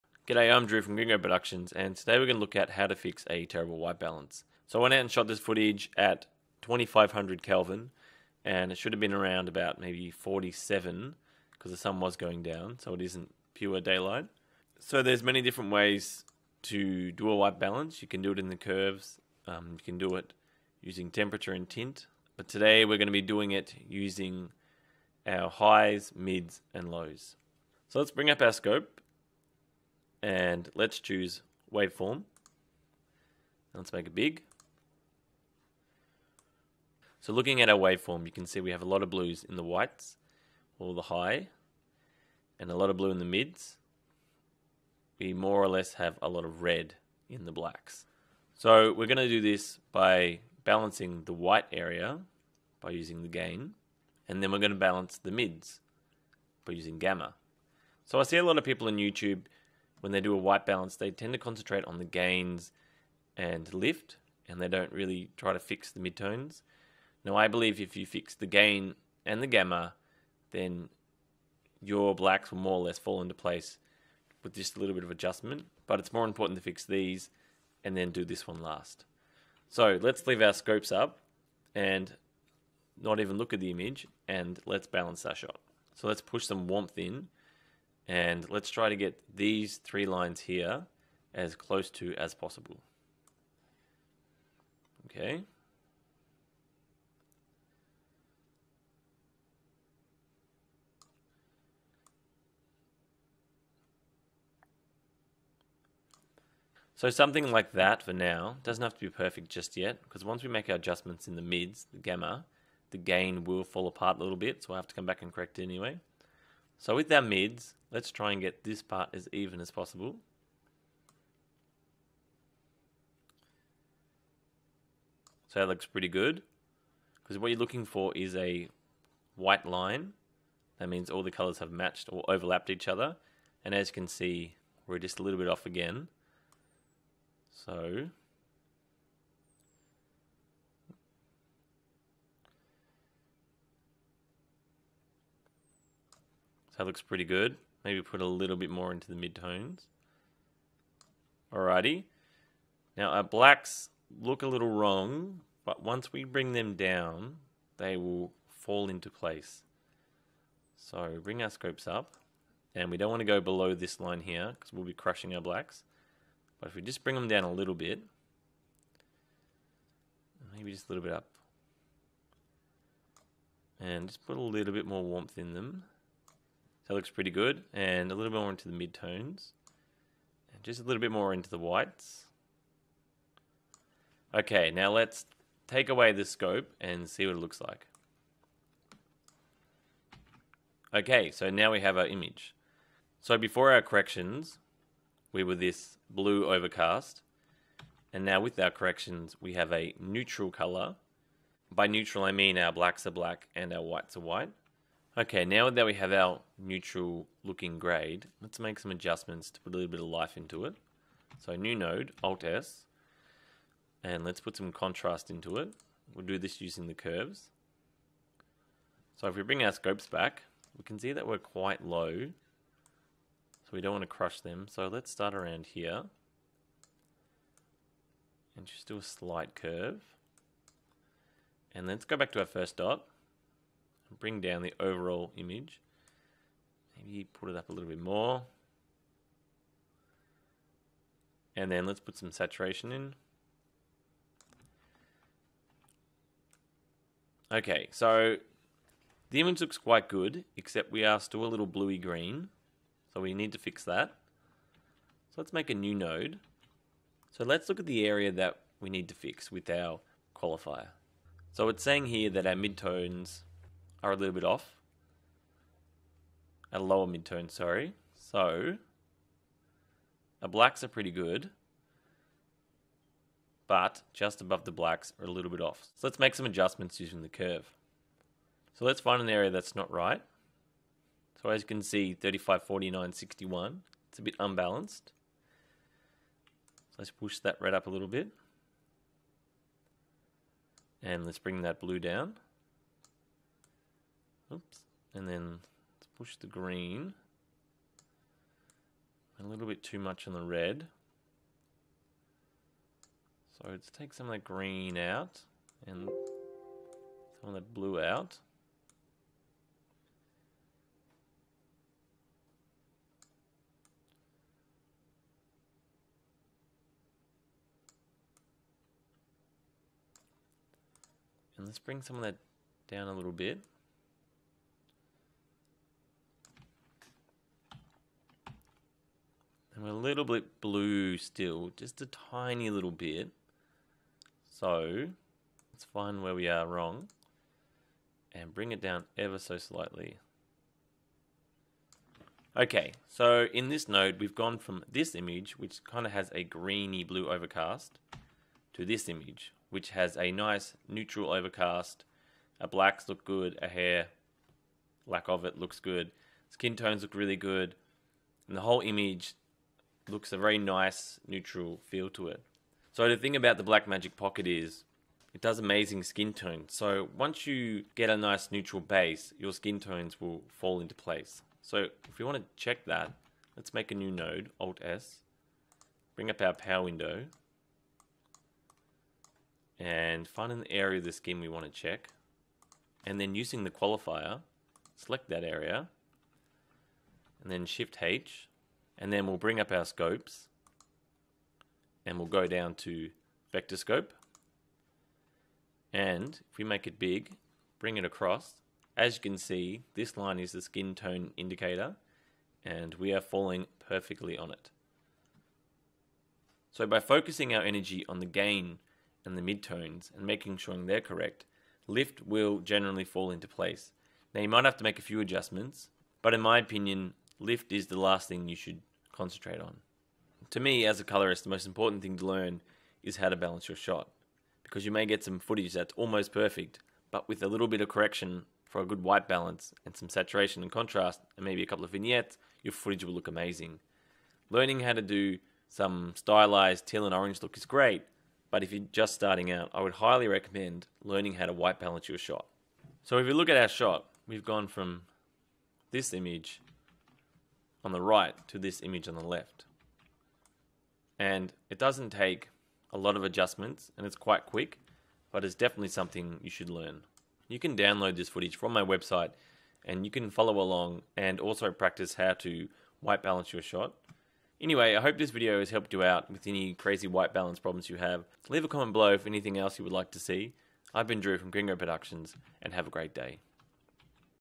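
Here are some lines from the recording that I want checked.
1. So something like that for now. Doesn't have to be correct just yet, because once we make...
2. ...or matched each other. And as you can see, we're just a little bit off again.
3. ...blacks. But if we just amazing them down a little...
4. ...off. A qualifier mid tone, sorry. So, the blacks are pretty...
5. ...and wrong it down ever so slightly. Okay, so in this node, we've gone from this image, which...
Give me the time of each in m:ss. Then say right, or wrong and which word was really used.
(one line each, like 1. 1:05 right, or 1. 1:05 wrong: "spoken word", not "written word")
1. 1:46 wrong: "perfect", not "correct"
2. 2:12 wrong: "overlapped", not "matched"
3. 2:45 wrong: "bring", not "amazing"
4. 4:24 wrong: "lower", not "qualifier"
5. 5:38 wrong: "bring", not "wrong".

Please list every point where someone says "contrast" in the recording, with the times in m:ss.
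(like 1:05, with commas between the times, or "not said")
3:34, 7:10.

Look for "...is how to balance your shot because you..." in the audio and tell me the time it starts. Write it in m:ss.
7:03.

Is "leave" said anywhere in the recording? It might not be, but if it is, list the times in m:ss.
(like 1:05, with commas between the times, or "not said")
1:20, 7:48.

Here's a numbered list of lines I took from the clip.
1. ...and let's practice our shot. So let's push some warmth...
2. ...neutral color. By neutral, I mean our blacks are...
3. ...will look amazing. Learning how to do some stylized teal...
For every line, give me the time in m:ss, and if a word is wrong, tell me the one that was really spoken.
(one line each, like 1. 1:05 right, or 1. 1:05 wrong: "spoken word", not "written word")
1. 1:24 wrong: "balance", not "practice"
2. 3:19 right
3. 7:13 right.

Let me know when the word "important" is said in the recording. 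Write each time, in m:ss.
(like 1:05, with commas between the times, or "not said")
1:16, 7:01.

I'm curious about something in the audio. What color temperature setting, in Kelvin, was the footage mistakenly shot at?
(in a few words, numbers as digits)
2500.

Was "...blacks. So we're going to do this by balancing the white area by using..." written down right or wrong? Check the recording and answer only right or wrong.
right.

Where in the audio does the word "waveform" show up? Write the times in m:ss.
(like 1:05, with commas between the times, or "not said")
0:31, 0:37.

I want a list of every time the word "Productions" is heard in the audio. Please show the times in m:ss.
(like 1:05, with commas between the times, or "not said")
0:01, 7:51.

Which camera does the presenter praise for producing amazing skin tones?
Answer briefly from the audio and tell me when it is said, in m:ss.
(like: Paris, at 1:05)
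Blackmagic Pocket, at 6:03.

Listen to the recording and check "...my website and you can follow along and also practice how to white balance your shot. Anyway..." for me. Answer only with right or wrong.
right.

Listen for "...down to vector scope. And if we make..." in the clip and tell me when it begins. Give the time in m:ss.
6:32.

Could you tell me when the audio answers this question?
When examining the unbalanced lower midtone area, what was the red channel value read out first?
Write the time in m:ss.
4:42.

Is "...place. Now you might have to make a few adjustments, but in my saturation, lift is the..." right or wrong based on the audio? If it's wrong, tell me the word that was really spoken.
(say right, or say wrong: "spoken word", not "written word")
wrong: "opinion", not "saturation".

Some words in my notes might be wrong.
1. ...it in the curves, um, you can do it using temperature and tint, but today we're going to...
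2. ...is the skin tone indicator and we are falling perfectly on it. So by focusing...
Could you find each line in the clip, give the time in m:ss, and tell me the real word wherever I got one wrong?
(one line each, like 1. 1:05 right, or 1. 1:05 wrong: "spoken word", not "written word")
1. 0:18 right
2. 6:40 right.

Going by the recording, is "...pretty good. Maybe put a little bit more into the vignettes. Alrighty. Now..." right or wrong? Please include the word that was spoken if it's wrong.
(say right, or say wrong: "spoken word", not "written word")
wrong: "midtones", not "vignettes".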